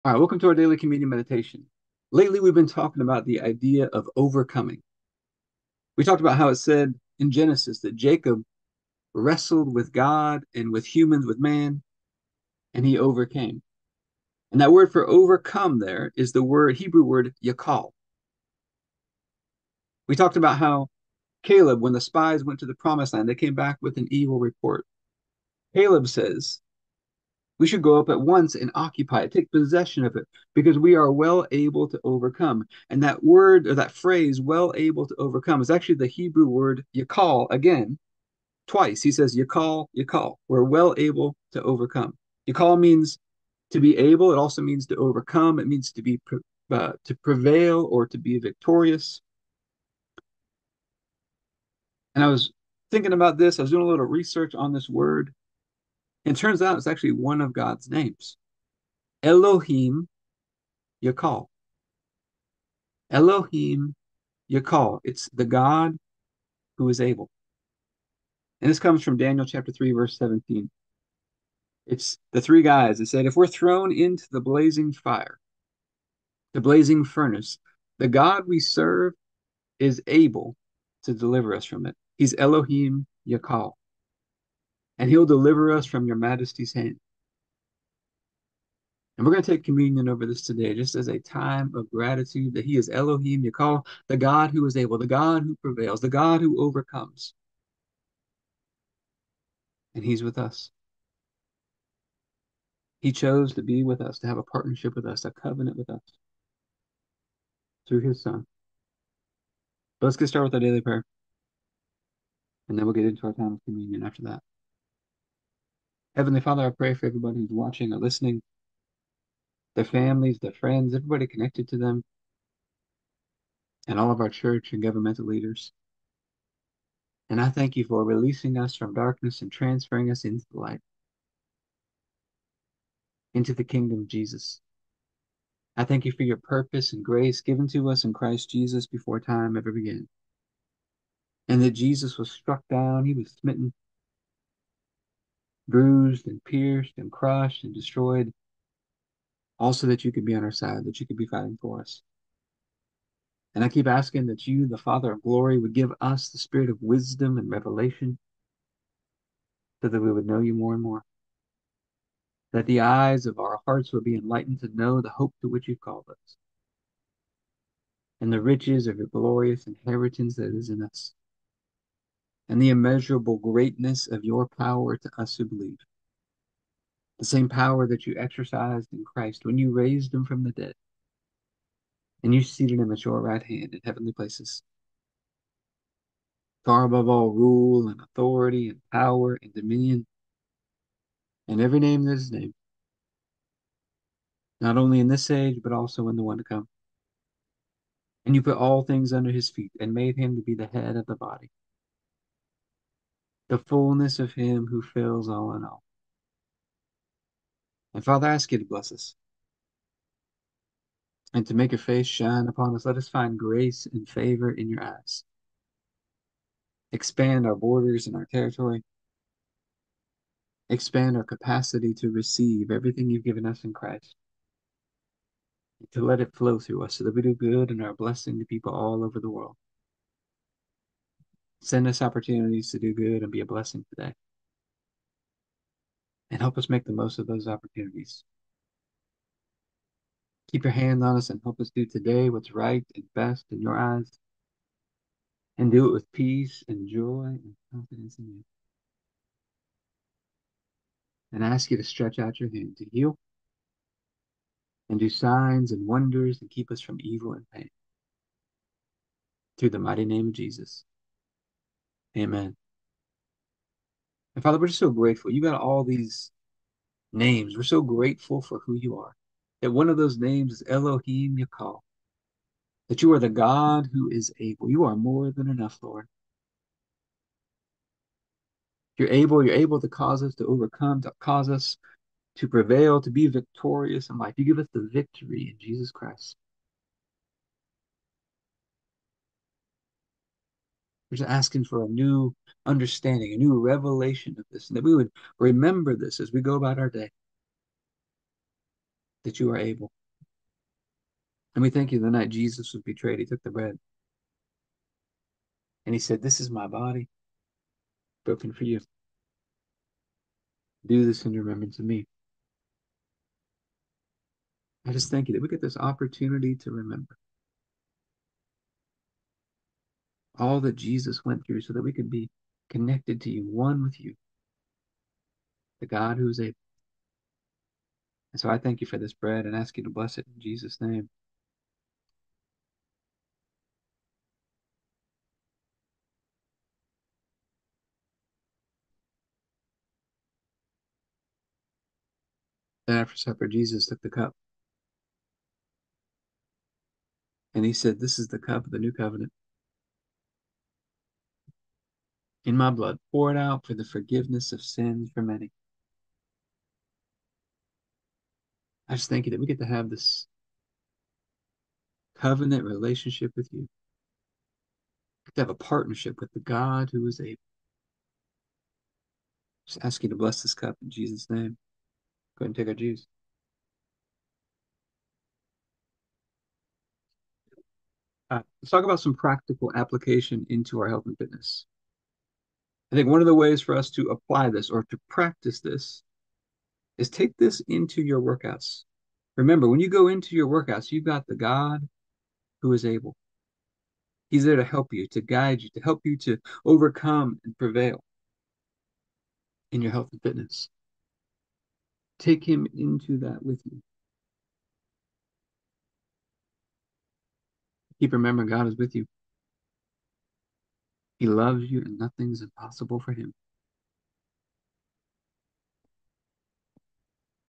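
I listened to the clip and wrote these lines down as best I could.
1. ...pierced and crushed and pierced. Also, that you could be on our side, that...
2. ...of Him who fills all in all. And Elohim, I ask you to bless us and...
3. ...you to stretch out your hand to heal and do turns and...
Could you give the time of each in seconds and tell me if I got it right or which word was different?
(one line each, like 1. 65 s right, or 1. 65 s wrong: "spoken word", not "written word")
1. 146 s wrong: "destroyed", not "pierced"
2. 204 s wrong: "Father", not "Elohim"
3. 251 s wrong: "signs", not "turns".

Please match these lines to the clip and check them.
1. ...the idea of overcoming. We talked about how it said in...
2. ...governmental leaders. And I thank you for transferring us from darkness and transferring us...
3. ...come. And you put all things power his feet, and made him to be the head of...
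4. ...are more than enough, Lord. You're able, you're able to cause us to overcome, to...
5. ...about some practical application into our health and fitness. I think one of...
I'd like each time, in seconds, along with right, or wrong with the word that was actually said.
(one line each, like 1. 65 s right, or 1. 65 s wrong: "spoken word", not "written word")
1. 3 s right
2. 124 s wrong: "releasing", not "transferring"
3. 196 s wrong: "under", not "power"
4. 274 s right
5. 378 s right.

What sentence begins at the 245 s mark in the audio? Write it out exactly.
And do it with peace and joy and confidence in you.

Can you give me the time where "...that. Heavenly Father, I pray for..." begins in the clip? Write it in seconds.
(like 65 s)
114 s.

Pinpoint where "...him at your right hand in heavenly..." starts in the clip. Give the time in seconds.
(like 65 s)
182 s.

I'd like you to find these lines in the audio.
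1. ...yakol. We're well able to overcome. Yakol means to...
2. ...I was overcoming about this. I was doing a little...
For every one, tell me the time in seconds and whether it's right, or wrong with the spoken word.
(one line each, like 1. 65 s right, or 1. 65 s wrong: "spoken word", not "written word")
1. 39 s right
2. 52 s wrong: "thinking", not "overcoming".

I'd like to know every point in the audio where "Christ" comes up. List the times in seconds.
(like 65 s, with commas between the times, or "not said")
138 s, 179 s, 223 s, 285 s.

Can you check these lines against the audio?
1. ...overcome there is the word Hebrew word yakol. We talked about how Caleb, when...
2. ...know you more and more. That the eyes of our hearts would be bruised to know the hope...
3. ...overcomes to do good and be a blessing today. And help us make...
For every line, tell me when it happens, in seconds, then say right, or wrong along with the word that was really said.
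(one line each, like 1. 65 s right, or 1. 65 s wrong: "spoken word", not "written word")
1. 15 s right
2. 160 s wrong: "enlightened", not "bruised"
3. 232 s wrong: "opportunities", not "overcomes".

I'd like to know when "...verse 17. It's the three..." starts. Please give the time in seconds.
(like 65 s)
69 s.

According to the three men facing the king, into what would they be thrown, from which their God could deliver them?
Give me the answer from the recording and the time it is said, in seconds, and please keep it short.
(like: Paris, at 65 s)
blazing furnace, at 76 s.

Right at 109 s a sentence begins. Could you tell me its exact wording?
But let's get started with our daily prayer.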